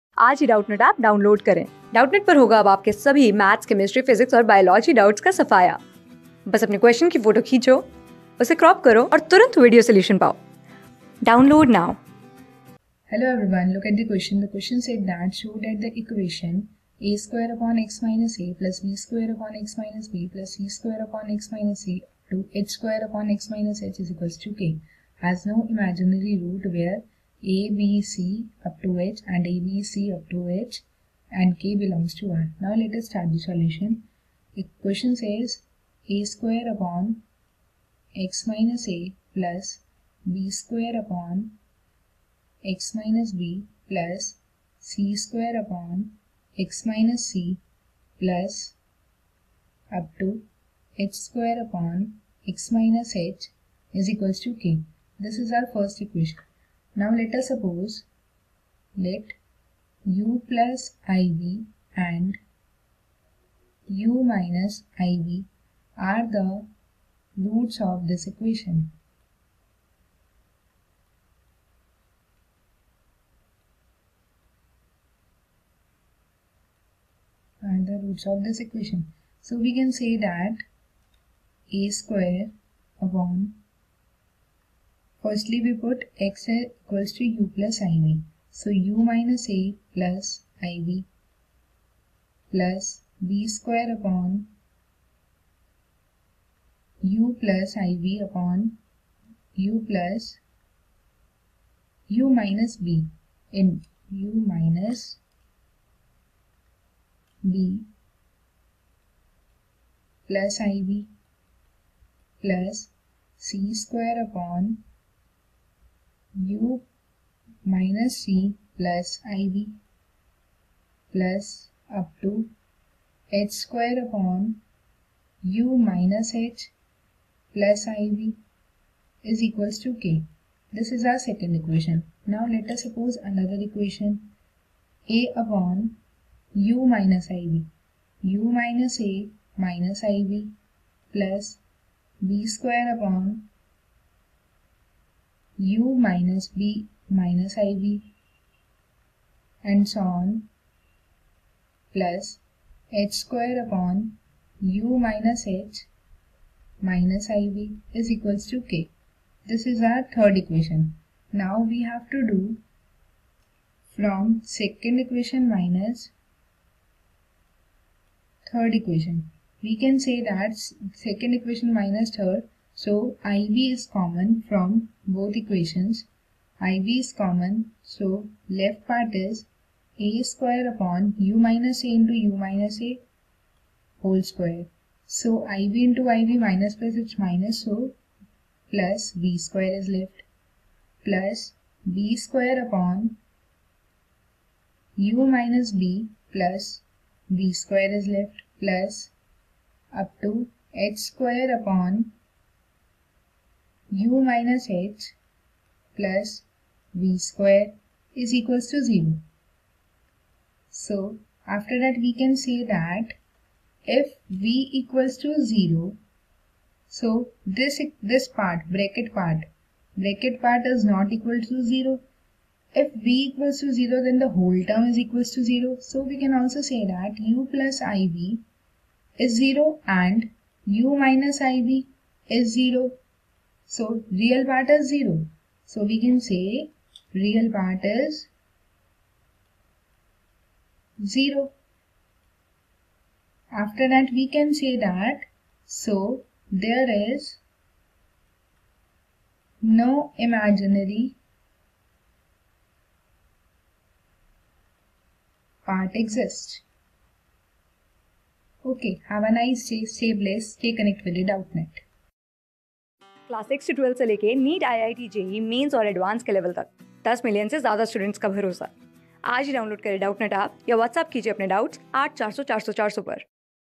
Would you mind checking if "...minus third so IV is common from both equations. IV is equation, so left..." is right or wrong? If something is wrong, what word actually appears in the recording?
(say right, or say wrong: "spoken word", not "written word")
wrong: "common", not "equation".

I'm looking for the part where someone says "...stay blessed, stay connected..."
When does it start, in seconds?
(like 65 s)
259 s.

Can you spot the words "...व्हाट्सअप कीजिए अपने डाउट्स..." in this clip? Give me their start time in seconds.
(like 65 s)
270 s.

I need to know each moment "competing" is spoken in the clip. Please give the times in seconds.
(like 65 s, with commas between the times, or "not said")
not said.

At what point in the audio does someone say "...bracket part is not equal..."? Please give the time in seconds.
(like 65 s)
219 s.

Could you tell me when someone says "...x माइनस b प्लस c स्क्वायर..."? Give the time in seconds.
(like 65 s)
19 s.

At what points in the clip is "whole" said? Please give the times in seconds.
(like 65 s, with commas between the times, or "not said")
184 s, 224 s.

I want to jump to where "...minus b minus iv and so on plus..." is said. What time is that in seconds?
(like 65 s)
146 s.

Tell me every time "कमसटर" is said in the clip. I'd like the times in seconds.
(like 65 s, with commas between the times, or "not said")
3 s.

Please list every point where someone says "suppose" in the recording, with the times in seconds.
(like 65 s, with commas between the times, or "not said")
57 s, 132 s.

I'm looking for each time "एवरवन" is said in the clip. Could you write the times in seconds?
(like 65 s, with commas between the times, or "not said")
13 s.